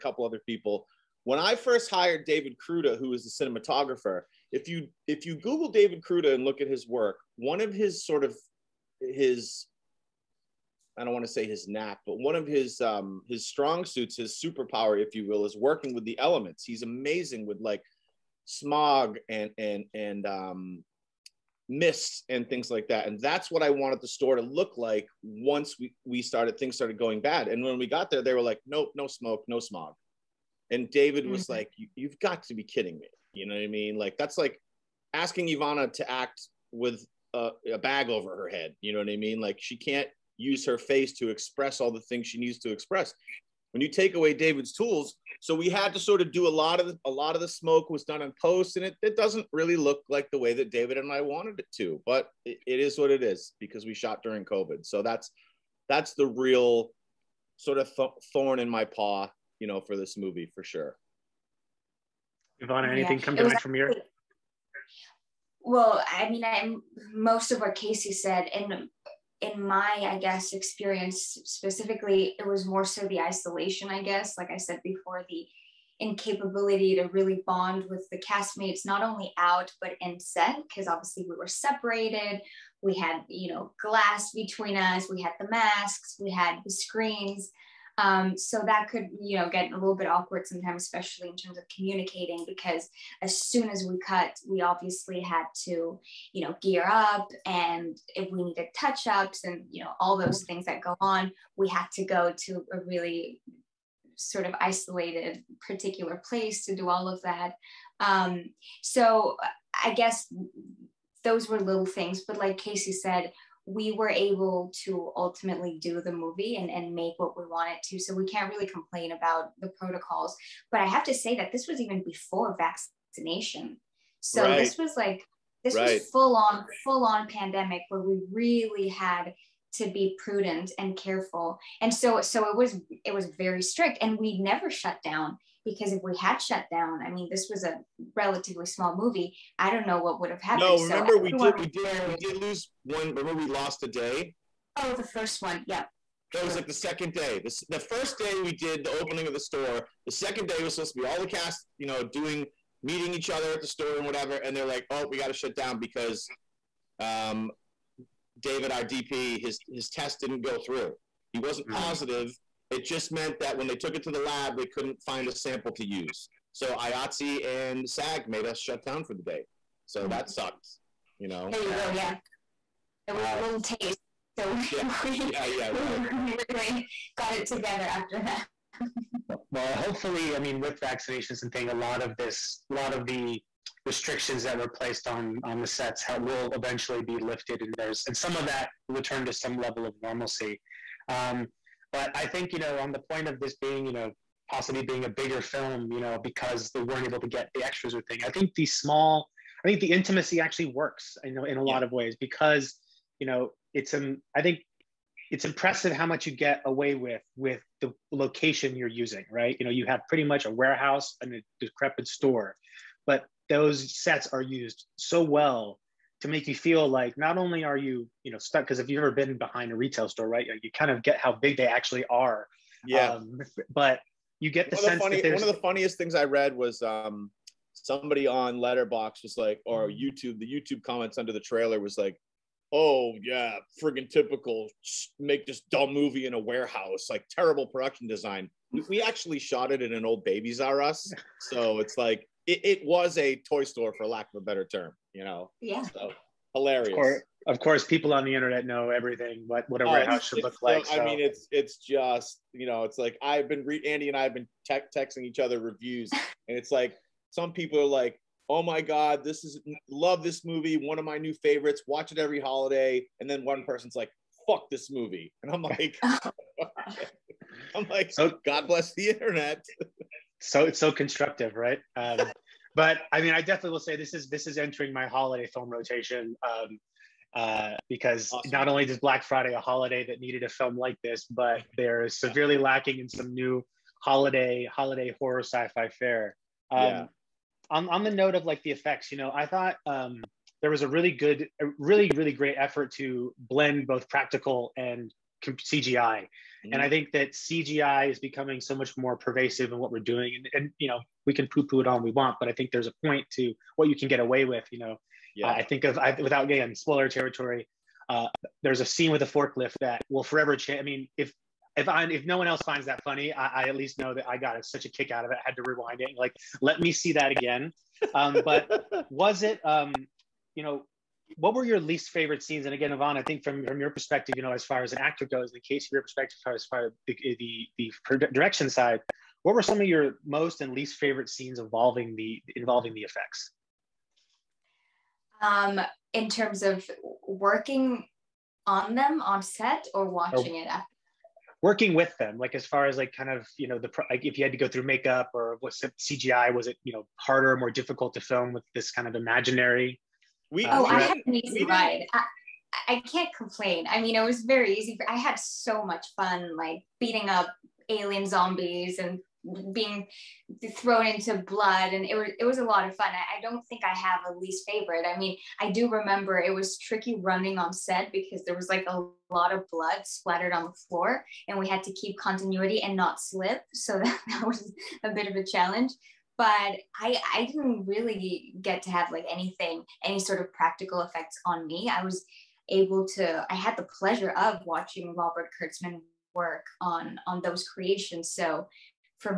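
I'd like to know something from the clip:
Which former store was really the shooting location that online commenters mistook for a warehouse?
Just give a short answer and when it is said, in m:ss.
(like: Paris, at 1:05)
Babies R Us, at 4:00.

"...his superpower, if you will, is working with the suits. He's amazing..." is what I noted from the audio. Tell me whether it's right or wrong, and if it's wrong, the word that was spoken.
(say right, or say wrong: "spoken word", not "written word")
wrong: "elements", not "suits".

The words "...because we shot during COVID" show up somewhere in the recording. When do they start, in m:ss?
0:53.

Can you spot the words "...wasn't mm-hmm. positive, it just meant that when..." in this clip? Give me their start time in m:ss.
2:41.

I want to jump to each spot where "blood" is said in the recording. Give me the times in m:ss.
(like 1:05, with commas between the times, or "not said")
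6:01, 6:09.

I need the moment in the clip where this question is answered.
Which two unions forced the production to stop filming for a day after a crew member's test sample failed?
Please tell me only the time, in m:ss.
2:46.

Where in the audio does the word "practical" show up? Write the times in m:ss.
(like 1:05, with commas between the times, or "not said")
4:54, 6:20.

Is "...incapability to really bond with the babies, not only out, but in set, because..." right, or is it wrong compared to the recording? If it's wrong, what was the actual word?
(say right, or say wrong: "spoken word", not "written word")
wrong: "castmates", not "babies".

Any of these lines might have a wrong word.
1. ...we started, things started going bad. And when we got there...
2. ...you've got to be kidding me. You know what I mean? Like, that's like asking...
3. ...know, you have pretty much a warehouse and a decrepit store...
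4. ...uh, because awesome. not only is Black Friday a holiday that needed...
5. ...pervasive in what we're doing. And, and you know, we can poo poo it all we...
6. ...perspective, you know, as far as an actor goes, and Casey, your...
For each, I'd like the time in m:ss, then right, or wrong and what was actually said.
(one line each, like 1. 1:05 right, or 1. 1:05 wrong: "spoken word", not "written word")
1. 0:26 right
2. 0:31 right
3. 3:29 right
4. 4:37 right
5. 4:59 right
6. 5:23 right.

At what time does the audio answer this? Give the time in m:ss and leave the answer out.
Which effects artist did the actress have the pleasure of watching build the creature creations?
6:25.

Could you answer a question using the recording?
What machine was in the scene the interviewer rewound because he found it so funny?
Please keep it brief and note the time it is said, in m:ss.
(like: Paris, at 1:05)
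a forklift, at 5:09.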